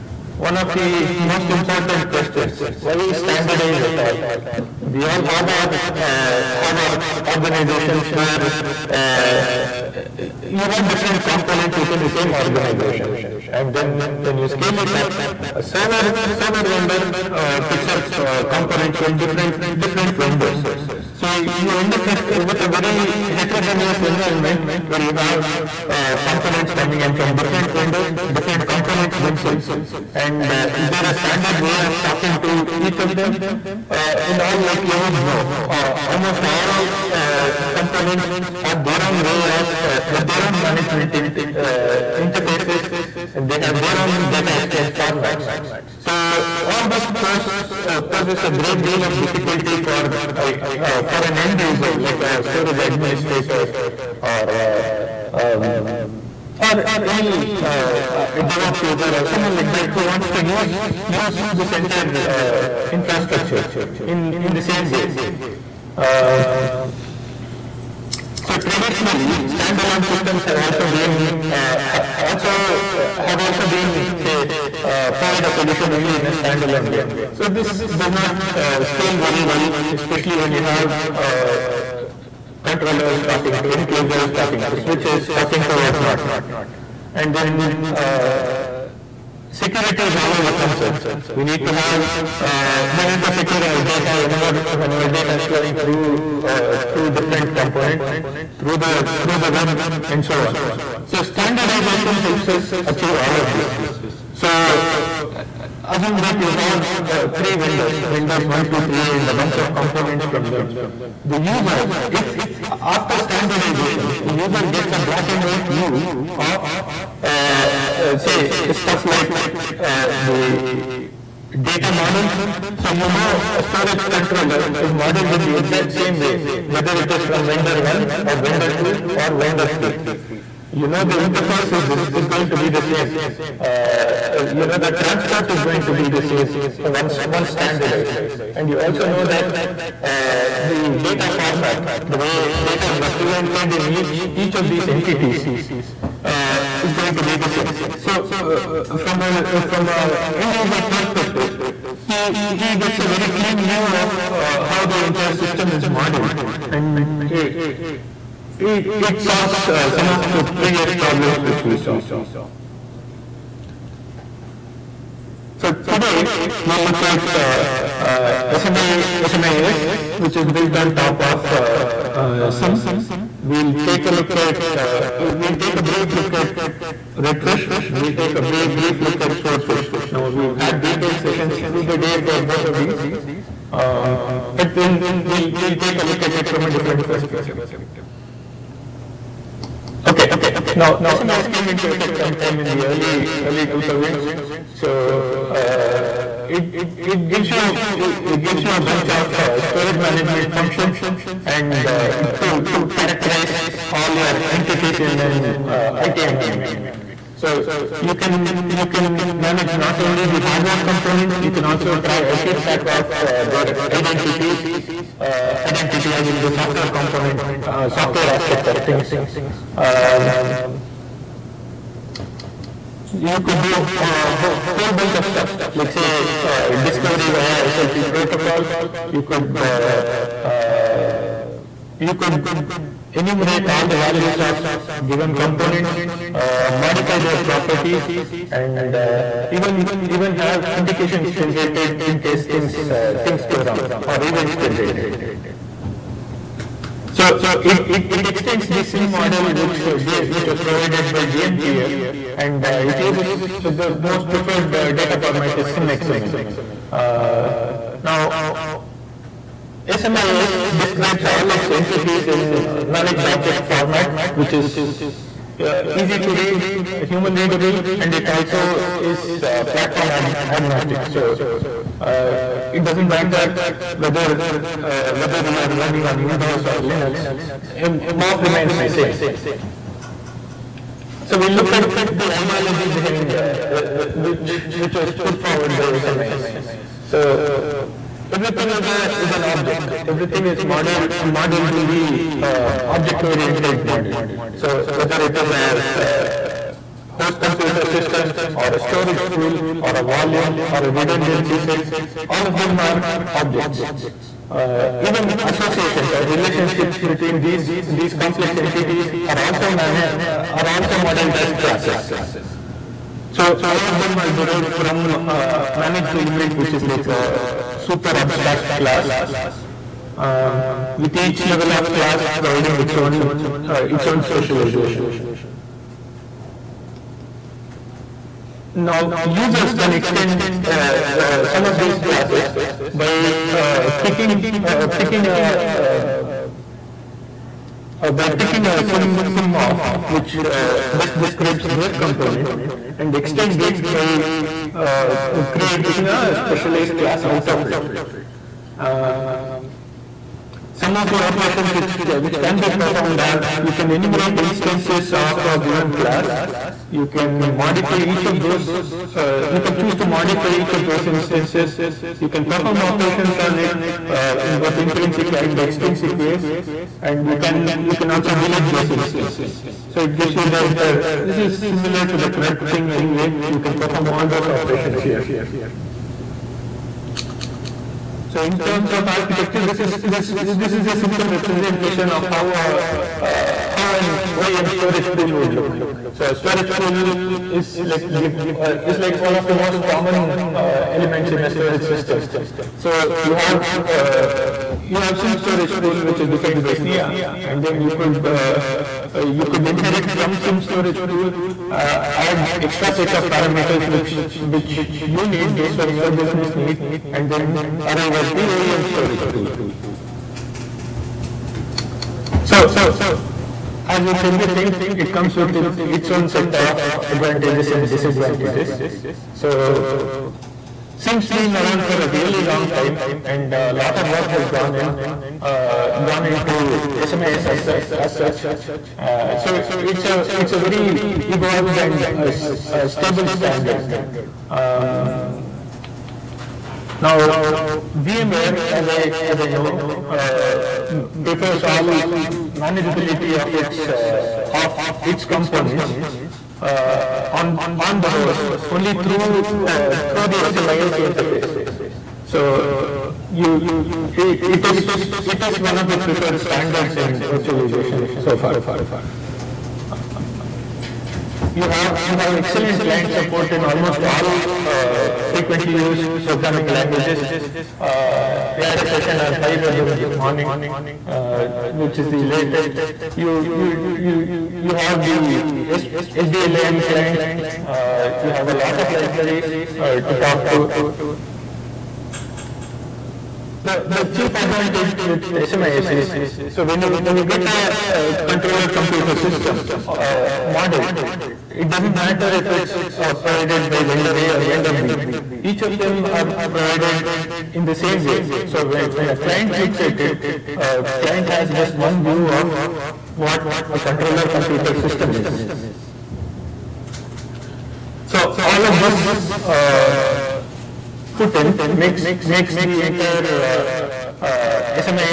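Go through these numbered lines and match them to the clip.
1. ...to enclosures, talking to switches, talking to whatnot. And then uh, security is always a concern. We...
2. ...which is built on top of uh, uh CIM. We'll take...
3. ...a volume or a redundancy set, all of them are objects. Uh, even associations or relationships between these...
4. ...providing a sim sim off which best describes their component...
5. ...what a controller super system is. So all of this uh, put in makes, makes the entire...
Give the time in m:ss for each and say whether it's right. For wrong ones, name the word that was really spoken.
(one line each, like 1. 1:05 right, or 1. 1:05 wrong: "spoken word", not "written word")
1. 1:23 right
2. 2:50 right
3. 4:59 right
4. 5:38 wrong: "picking", not "providing"
5. 8:23 wrong: "computer", not "super".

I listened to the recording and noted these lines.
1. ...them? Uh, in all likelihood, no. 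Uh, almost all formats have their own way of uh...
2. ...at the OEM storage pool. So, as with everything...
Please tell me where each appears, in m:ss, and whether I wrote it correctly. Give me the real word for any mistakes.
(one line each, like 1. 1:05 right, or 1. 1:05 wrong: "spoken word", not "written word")
1. 0:33 wrong: "components", not "formats"
2. 6:48 right.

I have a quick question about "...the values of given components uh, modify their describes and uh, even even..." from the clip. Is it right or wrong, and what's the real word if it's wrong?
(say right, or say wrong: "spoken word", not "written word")
wrong: "properties", not "describes".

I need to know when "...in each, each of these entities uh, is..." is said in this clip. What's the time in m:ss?
2:23.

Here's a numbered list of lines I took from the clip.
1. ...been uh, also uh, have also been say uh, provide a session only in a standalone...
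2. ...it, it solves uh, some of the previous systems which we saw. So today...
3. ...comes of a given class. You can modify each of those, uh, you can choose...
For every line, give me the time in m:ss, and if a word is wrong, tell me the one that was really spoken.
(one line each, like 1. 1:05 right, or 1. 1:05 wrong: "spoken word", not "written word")
1. 1:10 wrong: "solution", not "session"
2. 2:38 wrong: "problems", not "systems"
3. 5:54 wrong: "instances", not "comes".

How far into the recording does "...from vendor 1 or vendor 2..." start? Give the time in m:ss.
2:07.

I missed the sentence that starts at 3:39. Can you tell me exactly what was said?
Um, you could do a whole, whole bunch of stuff, like say uh, discovery via SLP protocol.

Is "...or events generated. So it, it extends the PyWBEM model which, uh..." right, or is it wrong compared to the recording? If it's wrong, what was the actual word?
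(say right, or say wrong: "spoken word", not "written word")
wrong: "CIM", not "PyWBEM".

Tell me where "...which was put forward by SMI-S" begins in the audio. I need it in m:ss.
4:44.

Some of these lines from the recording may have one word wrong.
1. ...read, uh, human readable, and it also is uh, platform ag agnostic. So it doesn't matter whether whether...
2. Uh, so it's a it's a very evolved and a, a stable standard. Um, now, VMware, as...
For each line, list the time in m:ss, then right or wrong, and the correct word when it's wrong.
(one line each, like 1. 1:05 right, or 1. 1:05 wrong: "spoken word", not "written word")
1. 4:26 right
2. 7:08 right.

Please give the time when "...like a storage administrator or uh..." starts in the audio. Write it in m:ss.
0:51.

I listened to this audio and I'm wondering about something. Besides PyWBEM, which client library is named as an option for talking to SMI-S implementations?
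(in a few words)
SBLIM client.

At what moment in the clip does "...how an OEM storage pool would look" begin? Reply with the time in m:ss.
6:23.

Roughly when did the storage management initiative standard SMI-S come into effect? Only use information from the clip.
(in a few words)
early 2000s.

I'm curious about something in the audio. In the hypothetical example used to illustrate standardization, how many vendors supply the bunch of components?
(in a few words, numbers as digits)
3.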